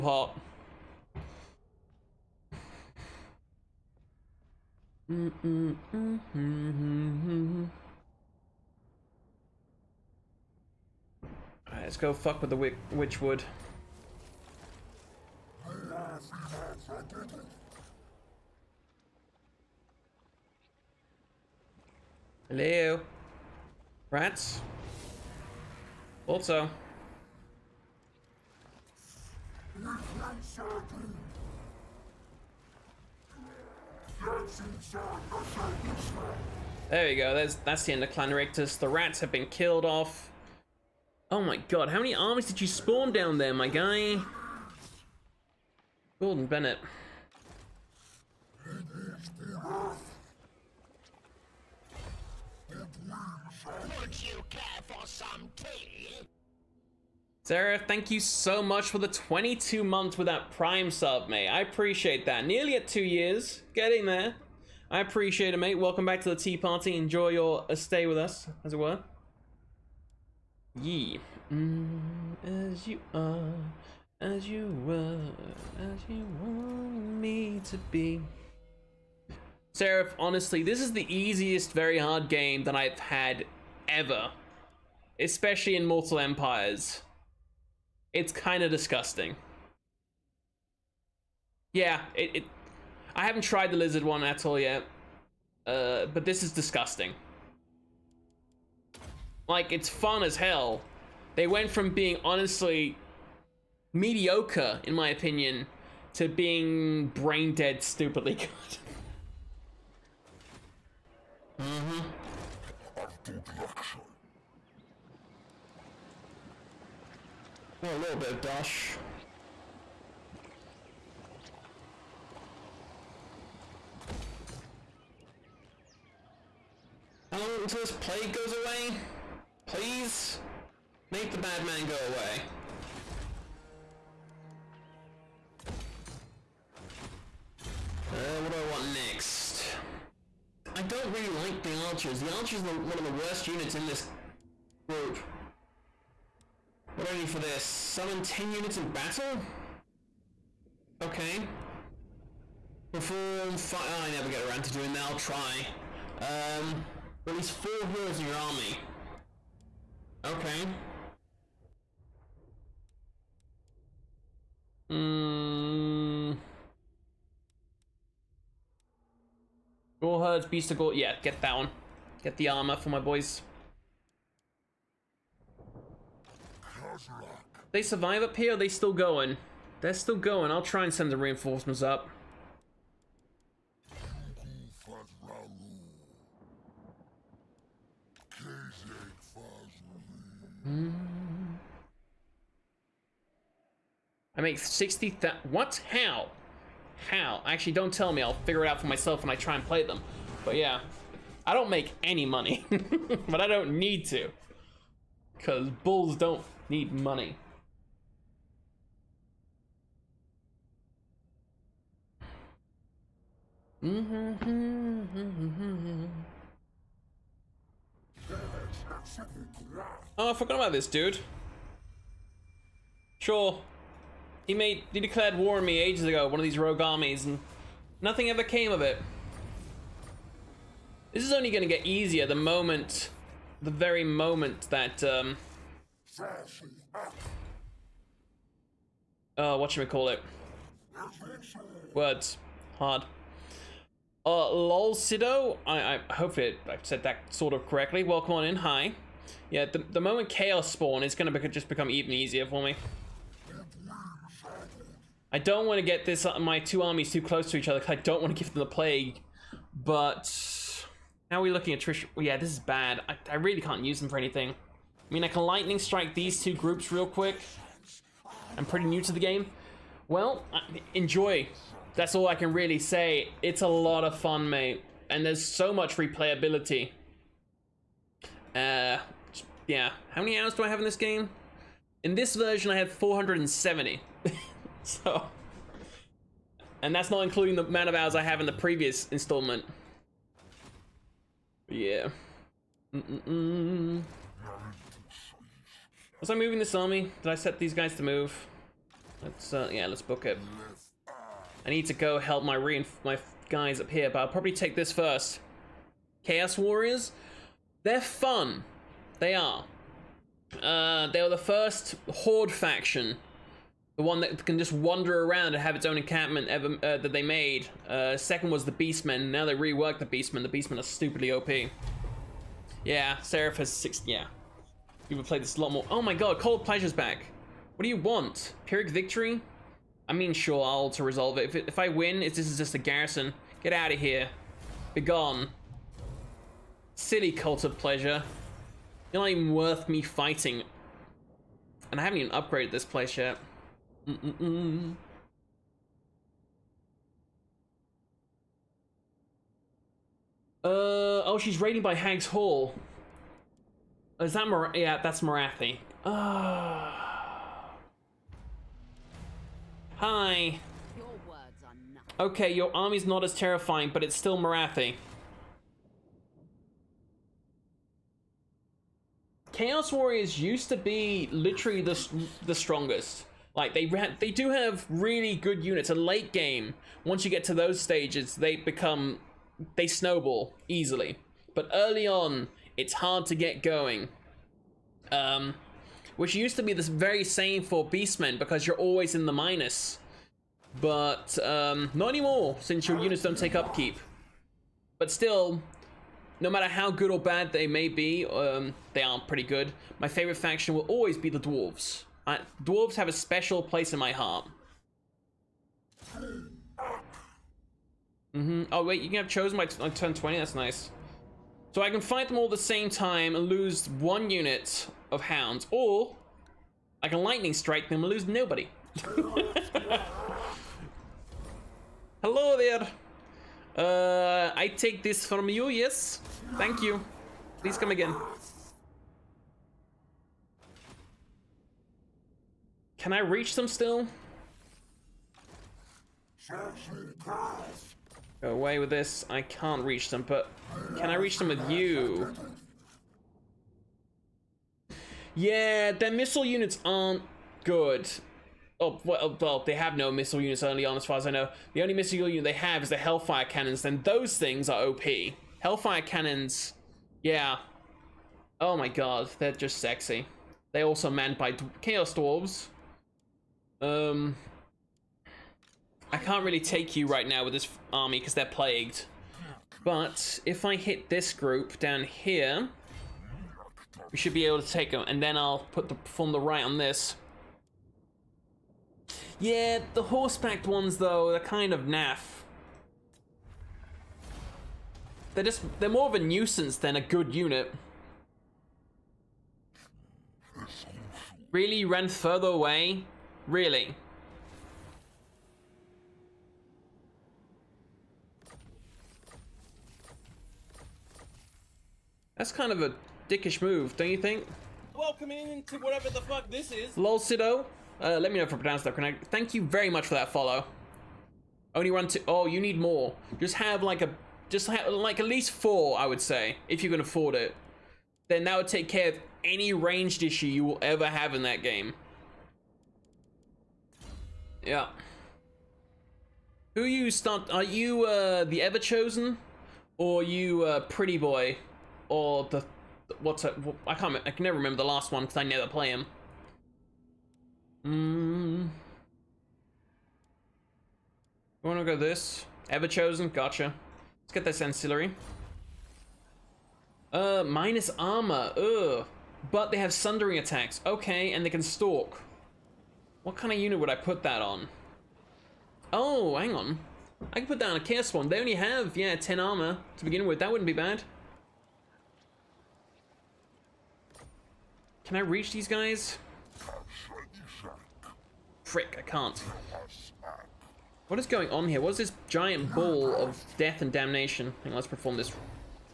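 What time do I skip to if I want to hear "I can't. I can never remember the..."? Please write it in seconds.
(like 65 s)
533 s.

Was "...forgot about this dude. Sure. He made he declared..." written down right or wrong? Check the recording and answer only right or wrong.
right.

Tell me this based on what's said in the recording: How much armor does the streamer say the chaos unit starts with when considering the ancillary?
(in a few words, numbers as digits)
10.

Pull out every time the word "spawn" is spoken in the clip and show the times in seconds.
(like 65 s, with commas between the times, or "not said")
42 s, 250 s.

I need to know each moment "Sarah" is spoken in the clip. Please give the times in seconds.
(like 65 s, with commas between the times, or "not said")
57 s.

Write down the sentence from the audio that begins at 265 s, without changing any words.
I mean, I can lightning strike these two groups real quick.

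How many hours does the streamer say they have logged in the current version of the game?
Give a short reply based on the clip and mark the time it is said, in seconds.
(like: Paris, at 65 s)
470, at 282 s.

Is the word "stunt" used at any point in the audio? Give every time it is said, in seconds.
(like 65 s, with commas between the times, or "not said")
527 s.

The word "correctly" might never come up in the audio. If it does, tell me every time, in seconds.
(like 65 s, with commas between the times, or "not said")
247 s, 508 s.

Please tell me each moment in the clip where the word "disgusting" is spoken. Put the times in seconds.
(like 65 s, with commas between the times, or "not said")
88 s, 96 s.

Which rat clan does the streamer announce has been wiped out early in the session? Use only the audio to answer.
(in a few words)
Clan Rictus.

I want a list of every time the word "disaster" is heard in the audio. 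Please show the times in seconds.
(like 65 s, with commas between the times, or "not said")
not said.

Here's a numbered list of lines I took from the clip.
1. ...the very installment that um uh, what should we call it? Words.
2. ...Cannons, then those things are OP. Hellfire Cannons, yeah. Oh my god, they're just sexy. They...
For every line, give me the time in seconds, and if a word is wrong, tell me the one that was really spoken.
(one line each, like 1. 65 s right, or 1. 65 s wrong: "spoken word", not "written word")
1. 233 s wrong: "moment", not "installment"
2. 453 s right.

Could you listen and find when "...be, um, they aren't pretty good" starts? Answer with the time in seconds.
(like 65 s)
397 s.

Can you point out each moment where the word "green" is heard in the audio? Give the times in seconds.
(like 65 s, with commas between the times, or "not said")
not said.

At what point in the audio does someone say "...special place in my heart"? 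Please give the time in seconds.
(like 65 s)
403 s.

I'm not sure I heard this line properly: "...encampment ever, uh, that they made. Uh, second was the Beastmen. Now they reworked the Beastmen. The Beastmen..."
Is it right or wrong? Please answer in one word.
right.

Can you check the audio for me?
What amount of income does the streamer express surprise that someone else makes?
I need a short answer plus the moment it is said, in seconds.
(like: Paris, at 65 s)
60,000, at 194 s.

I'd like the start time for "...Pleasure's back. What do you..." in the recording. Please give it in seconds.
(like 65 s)
326 s.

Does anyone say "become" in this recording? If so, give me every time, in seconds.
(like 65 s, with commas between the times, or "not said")
251 s, 378 s.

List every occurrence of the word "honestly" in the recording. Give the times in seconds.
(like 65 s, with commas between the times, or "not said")
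80 s, 102 s.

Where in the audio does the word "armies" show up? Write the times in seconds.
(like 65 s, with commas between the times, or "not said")
42 s, 226 s, 256 s.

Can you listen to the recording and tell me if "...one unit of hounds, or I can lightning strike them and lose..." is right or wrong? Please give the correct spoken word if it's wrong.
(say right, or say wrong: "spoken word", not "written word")
right.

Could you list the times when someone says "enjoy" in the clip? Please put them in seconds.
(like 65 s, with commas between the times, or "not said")
66 s, 270 s.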